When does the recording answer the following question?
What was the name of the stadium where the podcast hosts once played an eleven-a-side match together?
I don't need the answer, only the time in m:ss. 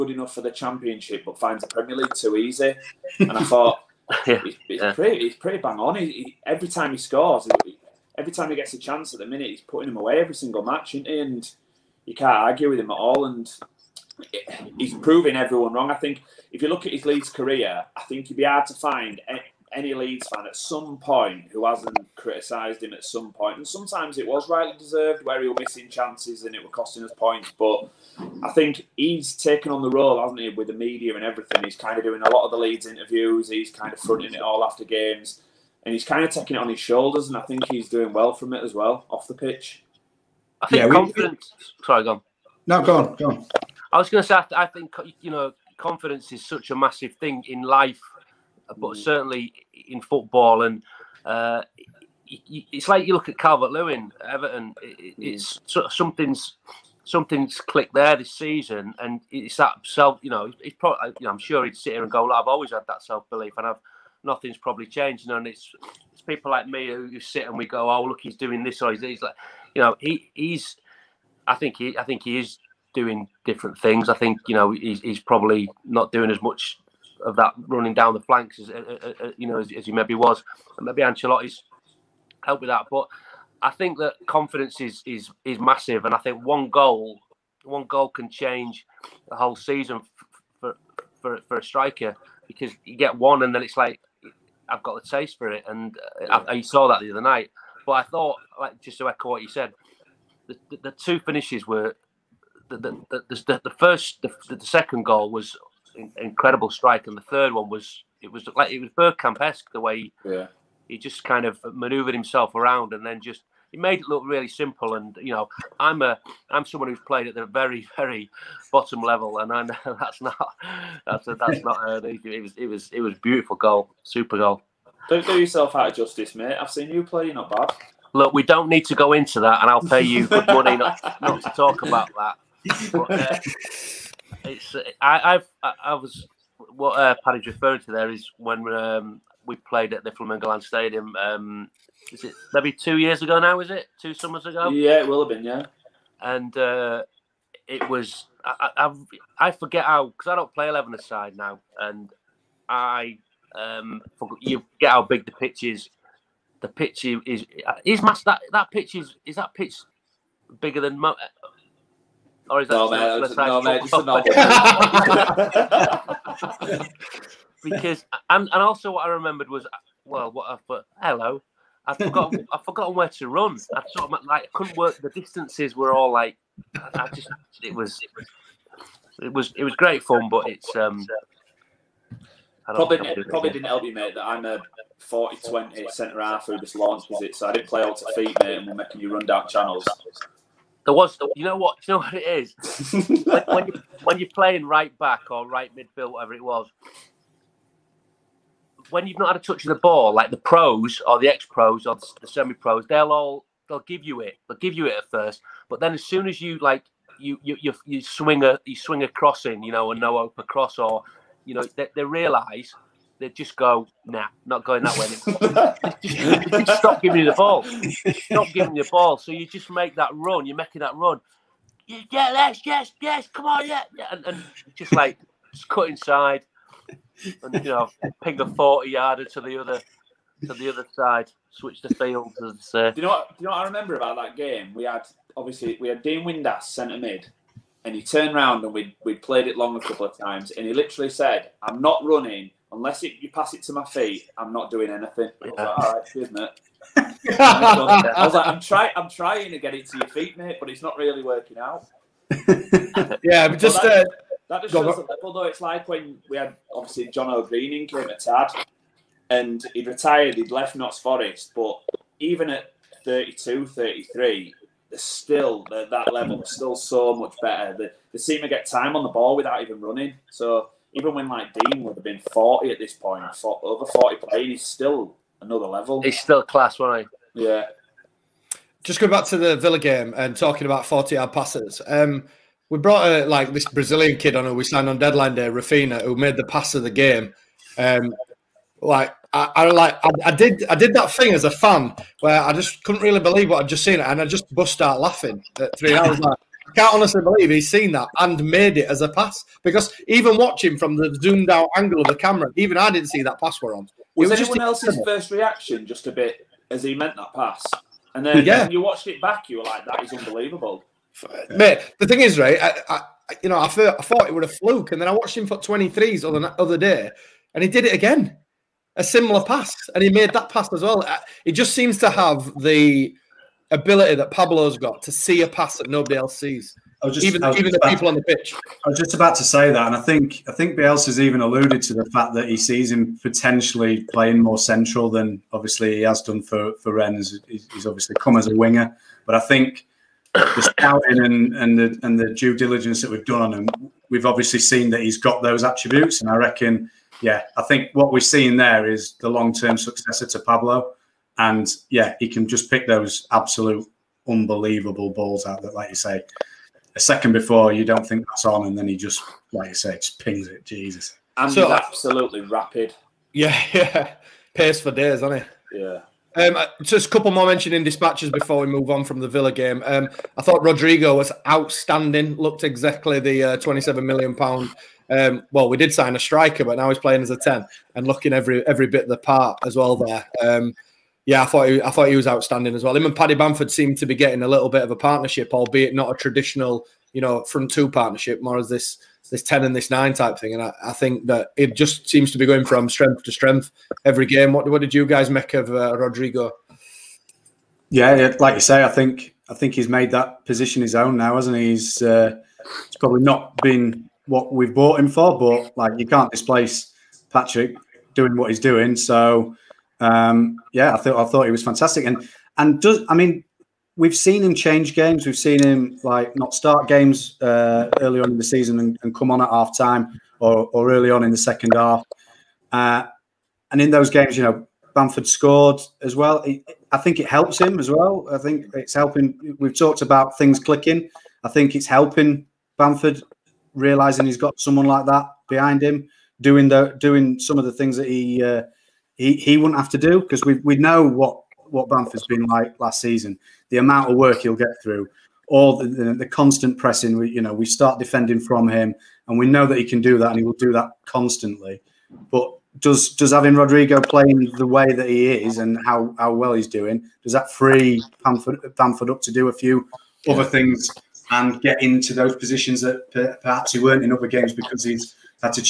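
2:20.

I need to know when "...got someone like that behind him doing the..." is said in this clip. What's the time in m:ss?
7:14.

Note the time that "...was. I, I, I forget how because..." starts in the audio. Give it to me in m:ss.
2:27.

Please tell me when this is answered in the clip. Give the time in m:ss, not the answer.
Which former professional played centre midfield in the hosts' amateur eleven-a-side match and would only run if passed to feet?
3:56.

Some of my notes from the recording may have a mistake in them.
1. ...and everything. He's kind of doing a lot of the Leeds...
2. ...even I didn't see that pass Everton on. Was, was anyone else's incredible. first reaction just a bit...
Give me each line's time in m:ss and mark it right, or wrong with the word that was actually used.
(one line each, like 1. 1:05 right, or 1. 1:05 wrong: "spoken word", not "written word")
1. 0:31 right
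2. 5:02 wrong: "Were", not "Everton".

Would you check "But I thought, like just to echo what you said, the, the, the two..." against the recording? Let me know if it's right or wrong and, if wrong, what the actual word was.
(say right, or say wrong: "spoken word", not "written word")
right.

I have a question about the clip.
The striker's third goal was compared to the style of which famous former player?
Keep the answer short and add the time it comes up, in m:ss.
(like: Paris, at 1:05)
Bergkamp, at 1:48.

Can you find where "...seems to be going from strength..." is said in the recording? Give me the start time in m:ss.
6:32.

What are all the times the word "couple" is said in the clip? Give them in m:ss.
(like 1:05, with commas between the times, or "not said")
3:59, 6:07.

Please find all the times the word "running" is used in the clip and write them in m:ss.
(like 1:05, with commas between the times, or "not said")
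1:17, 4:02, 4:29.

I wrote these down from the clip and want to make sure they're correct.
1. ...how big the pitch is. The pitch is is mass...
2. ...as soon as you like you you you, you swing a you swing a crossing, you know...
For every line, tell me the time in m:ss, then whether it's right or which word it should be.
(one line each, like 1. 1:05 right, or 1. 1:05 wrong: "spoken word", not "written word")
1. 2:34 right
2. 3:25 right.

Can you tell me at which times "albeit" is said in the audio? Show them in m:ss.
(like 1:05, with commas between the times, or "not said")
6:25.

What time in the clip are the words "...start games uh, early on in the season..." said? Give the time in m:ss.
6:56.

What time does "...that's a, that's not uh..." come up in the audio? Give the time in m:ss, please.
2:01.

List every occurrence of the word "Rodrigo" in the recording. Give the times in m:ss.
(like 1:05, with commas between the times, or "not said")
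6:10, 6:35, 7:33.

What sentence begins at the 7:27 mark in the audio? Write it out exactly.
We, you know, we start defending from him and we know that he can do that and he will do that constantly.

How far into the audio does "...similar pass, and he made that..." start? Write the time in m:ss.
5:19.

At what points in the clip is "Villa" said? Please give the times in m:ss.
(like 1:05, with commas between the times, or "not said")
4:39, 6:09.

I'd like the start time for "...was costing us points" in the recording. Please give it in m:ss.
0:26.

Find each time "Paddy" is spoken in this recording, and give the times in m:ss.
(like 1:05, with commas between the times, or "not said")
2:17, 6:23.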